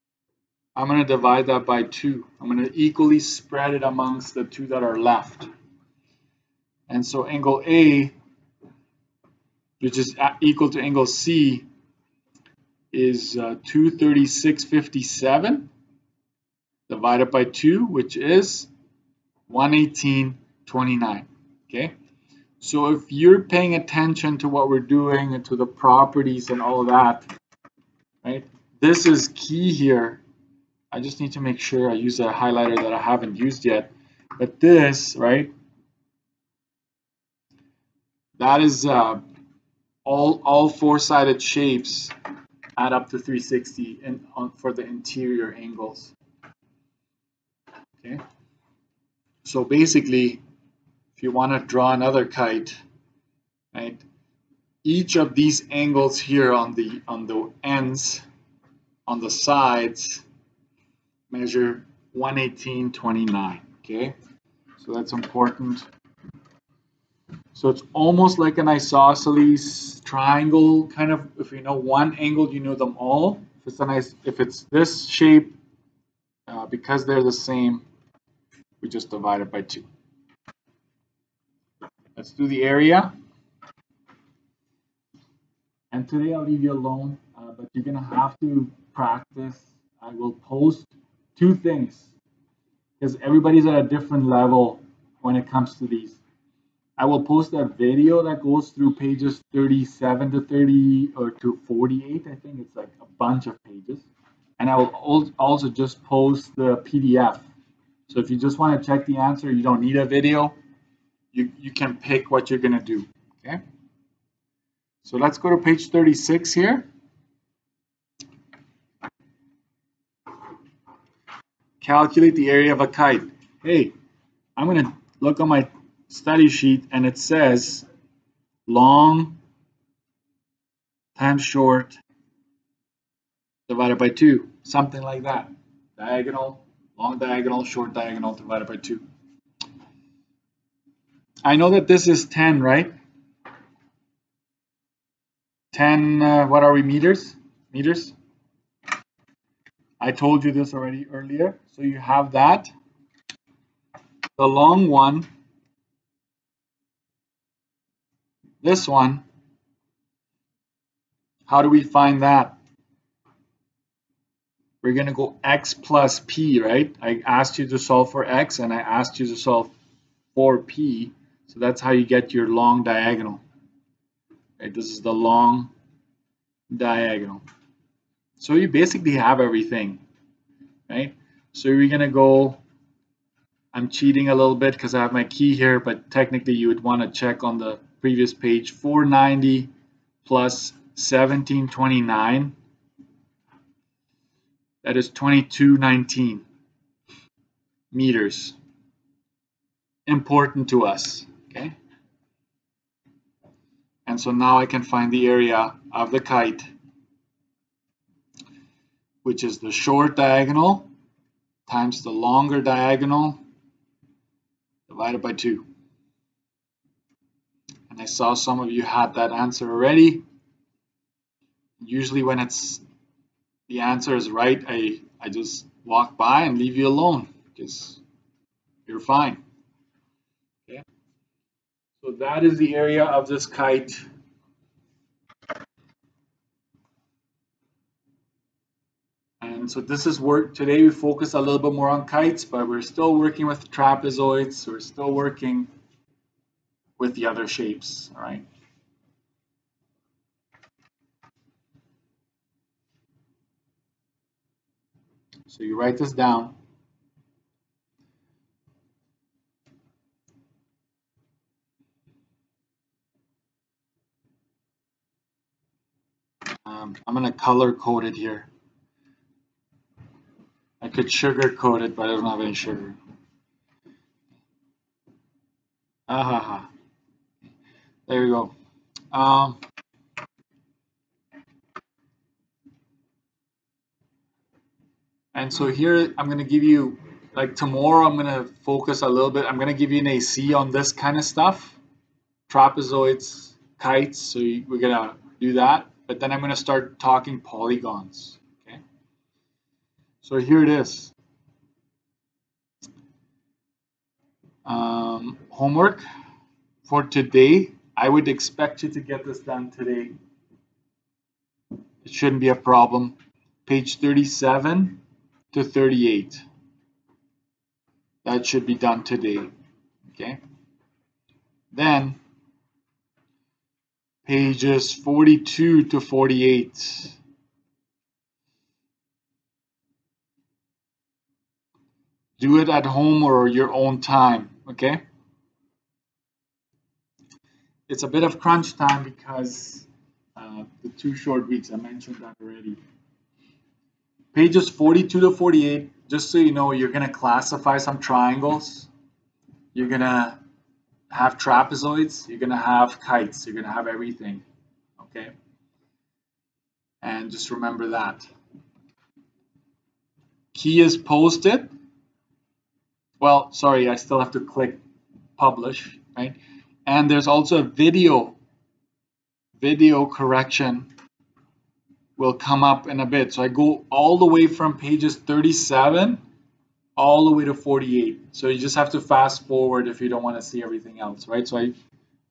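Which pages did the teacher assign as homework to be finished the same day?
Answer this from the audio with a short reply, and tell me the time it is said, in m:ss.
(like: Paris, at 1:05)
37 to 38, at 5:13.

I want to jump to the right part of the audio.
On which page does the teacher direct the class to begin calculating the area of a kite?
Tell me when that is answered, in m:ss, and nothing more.
1:55.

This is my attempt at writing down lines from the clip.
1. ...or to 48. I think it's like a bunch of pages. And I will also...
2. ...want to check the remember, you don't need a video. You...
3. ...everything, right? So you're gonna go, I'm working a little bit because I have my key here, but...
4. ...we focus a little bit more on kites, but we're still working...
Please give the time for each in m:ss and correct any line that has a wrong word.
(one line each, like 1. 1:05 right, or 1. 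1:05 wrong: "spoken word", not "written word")
1. 1:41 right
2. 1:48 wrong: "answer", not "remember"
3. 2:59 wrong: "cheating", not "working"
4. 4:00 right.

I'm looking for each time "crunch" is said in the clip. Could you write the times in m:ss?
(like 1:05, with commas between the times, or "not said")
5:38.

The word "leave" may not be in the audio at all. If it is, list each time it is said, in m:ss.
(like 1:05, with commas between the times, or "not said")
1:26, 3:46.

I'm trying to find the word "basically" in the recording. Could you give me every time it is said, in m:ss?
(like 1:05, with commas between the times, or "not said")
0:49, 2:58.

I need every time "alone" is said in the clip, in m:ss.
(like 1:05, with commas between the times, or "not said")
1:26, 3:46.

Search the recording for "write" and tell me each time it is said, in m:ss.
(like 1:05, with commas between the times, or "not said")
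4:15.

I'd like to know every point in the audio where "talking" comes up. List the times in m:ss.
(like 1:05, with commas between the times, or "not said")
4:56.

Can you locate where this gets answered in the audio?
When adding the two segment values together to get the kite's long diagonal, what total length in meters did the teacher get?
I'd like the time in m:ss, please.
3:15.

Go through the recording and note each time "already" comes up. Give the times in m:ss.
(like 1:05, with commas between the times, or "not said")
2:30, 3:39, 5:42.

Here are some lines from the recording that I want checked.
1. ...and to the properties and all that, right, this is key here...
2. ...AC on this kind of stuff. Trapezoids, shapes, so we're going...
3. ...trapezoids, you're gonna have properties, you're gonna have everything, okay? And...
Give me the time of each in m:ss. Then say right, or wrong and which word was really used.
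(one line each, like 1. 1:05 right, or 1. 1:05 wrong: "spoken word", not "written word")
1. 0:25 right
2. 4:50 wrong: "kites", not "shapes"
3. 5:51 wrong: "kites", not "properties".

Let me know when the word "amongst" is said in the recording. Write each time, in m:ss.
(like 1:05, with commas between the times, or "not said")
0:03.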